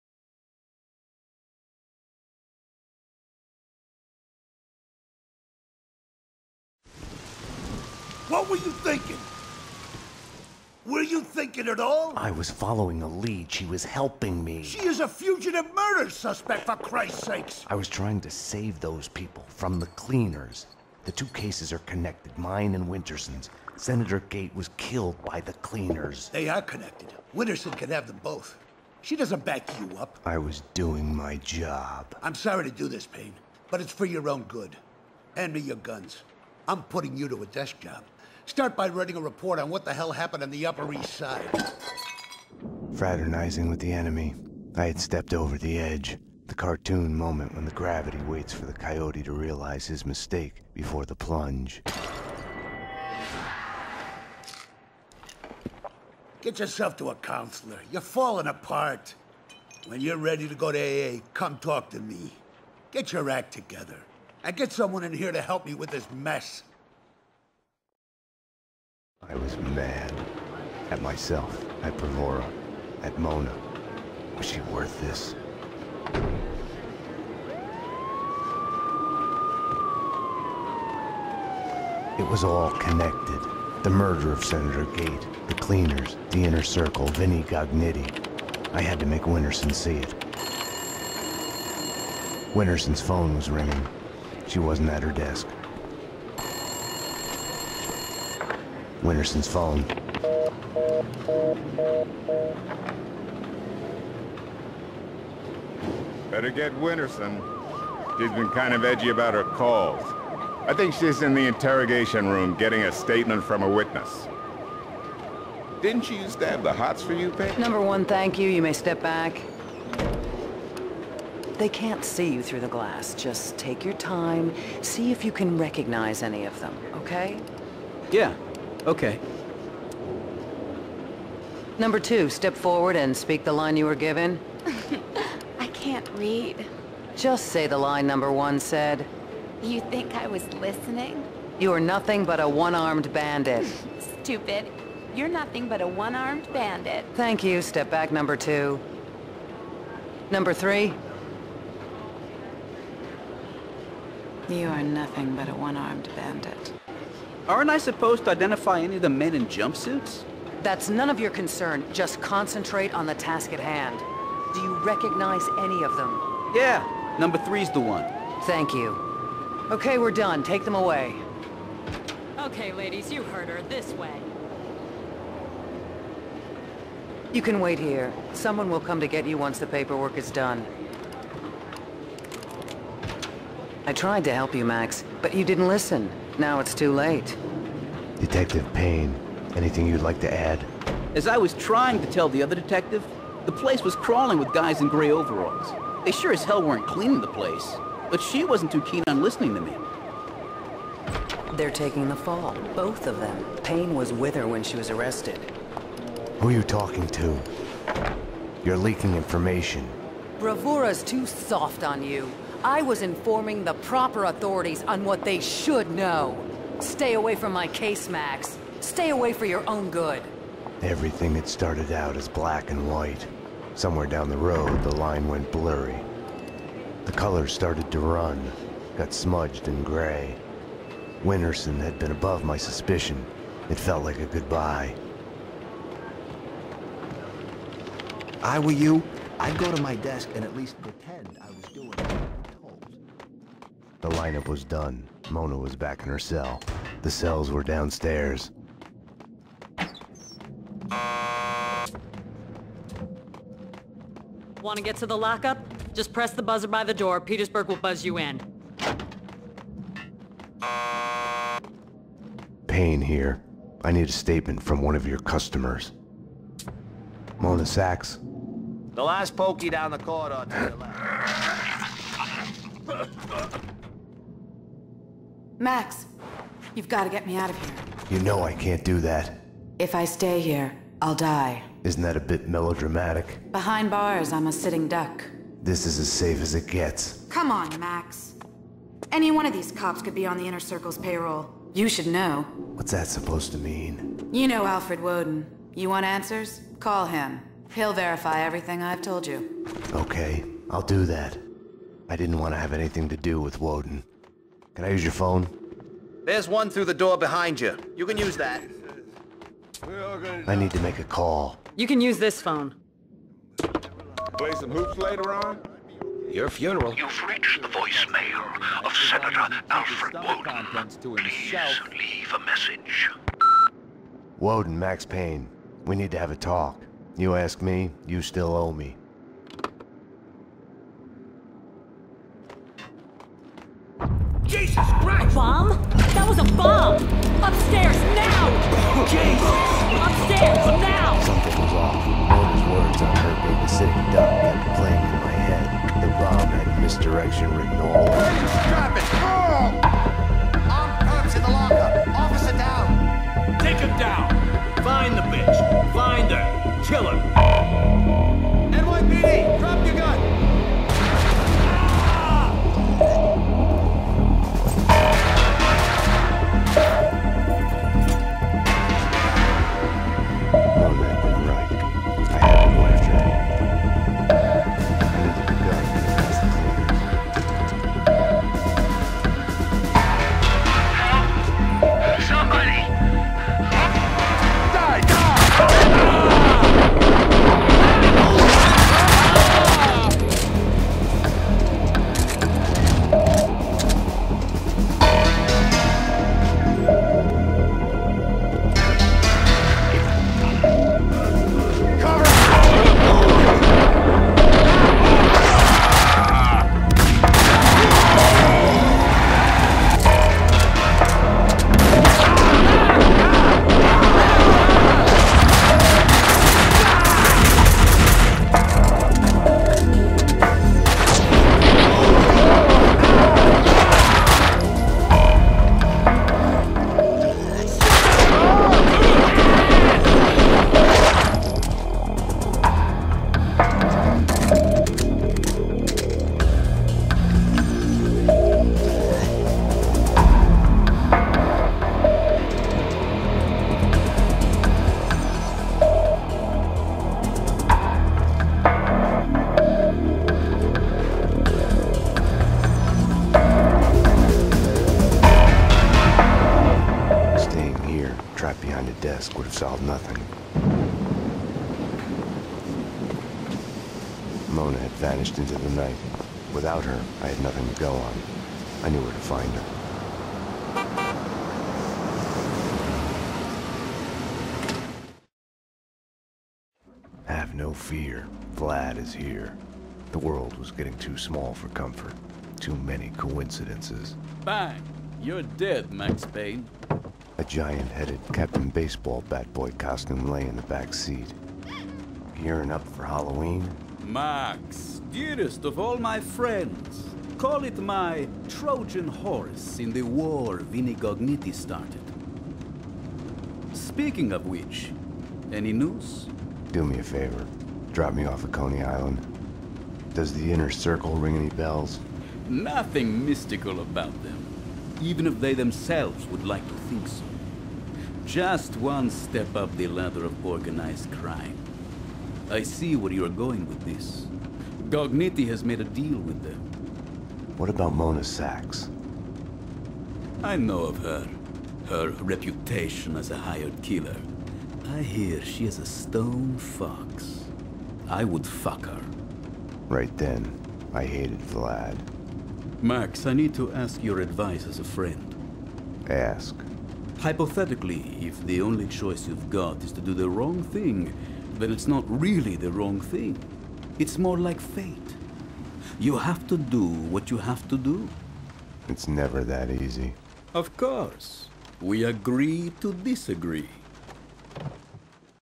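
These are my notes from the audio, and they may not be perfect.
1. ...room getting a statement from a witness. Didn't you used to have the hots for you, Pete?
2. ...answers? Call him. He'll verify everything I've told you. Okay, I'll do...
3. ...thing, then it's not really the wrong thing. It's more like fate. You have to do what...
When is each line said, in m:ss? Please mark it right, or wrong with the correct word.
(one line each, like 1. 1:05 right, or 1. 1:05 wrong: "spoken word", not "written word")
1. 1:52 right
2. 4:56 right
3. 9:10 right.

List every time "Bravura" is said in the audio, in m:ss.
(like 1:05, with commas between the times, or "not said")
1:11, 3:30.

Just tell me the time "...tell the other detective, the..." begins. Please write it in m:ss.
3:12.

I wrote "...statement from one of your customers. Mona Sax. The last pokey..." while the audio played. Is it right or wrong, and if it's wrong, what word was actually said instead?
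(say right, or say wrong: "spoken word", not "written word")
right.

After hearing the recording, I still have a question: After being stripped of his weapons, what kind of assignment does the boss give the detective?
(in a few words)
a desk job.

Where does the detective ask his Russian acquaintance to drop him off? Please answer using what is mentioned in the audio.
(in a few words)
Coney Island.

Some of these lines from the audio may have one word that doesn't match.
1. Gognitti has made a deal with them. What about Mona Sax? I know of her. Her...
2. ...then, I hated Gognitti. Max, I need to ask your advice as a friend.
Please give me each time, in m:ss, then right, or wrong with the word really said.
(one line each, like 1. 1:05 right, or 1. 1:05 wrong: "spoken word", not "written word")
1. 8:44 right
2. 9:00 wrong: "Vlad", not "Gognitti".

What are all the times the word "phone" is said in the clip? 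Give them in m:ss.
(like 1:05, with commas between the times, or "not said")
1:33, 1:39, 5:05, 5:12.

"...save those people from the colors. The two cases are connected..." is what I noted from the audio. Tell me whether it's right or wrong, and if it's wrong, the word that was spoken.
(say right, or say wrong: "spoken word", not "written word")
wrong: "cleaners", not "colors".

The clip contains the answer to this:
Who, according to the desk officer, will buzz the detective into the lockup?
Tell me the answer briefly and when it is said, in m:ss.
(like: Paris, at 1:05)
Petersburg, at 4:17.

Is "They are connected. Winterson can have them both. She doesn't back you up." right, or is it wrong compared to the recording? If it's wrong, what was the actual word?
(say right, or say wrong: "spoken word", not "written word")
right.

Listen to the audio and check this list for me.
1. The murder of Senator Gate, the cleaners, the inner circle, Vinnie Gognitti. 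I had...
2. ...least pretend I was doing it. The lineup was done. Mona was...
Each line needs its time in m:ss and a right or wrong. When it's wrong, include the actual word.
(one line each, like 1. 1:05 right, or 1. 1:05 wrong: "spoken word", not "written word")
1. 1:23 right
2. 4:00 right.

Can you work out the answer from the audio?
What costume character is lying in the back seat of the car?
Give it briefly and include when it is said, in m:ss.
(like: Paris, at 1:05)
Captain Baseball Bat Boy, at 8:08.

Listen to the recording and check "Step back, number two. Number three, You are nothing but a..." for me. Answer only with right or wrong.
right.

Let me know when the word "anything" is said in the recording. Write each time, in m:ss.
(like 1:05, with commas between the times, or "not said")
3:09, 5:02.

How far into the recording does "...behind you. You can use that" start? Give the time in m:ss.
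5:07.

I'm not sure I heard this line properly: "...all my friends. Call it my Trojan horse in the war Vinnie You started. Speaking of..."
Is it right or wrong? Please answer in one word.
wrong.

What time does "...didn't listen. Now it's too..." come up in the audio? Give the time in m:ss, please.
3:05.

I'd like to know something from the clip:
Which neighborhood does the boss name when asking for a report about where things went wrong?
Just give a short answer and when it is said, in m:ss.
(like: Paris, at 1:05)
Upper East Side, at 0:40.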